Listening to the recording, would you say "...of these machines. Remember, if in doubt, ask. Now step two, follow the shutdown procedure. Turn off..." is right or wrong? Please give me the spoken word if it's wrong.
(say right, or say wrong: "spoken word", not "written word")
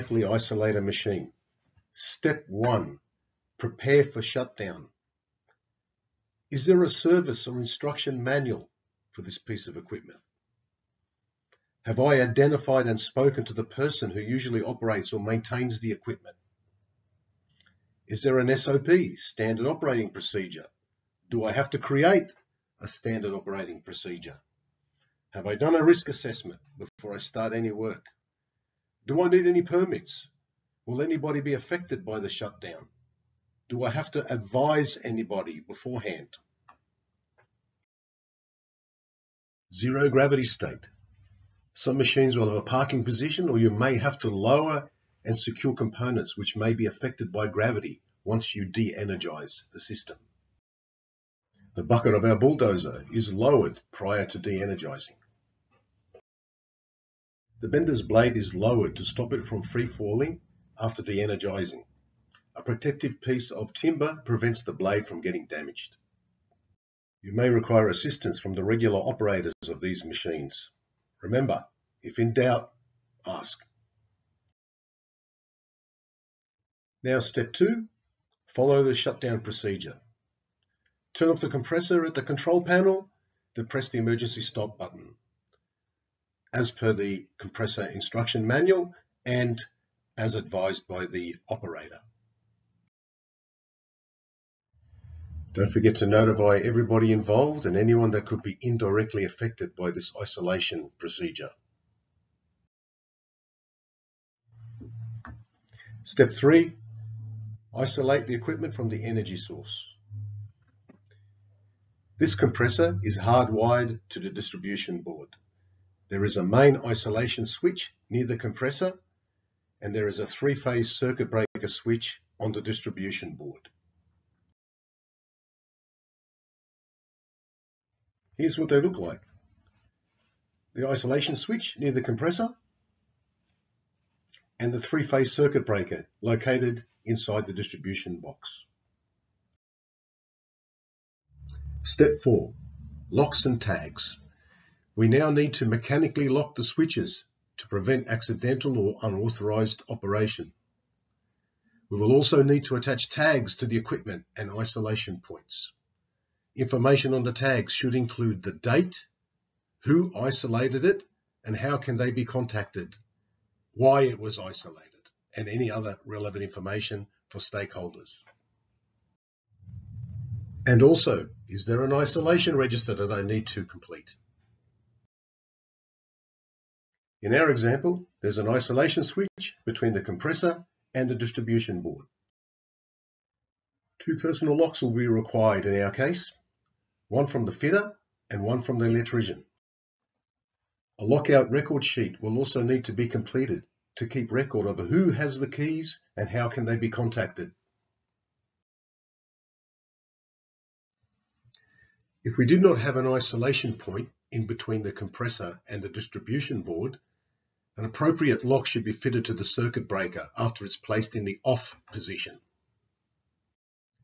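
right.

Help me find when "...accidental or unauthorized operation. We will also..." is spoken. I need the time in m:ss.
2:28.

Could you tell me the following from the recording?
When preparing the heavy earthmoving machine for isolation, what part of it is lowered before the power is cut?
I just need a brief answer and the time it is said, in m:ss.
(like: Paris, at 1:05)
The bucket, at 0:51.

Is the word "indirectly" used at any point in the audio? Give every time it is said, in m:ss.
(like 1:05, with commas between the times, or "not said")
1:38.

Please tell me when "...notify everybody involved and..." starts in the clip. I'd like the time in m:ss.
1:36.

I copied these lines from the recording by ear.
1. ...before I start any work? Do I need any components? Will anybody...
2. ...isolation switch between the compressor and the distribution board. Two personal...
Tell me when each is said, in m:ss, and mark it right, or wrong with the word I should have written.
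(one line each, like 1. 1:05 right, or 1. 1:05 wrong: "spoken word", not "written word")
1. 0:26 wrong: "permits", not "components"
2. 2:58 right.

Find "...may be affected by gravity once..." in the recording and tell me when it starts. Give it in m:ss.
0:46.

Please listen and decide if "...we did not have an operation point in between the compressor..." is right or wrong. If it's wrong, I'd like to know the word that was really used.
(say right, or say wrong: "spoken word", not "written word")
wrong: "isolation", not "operation".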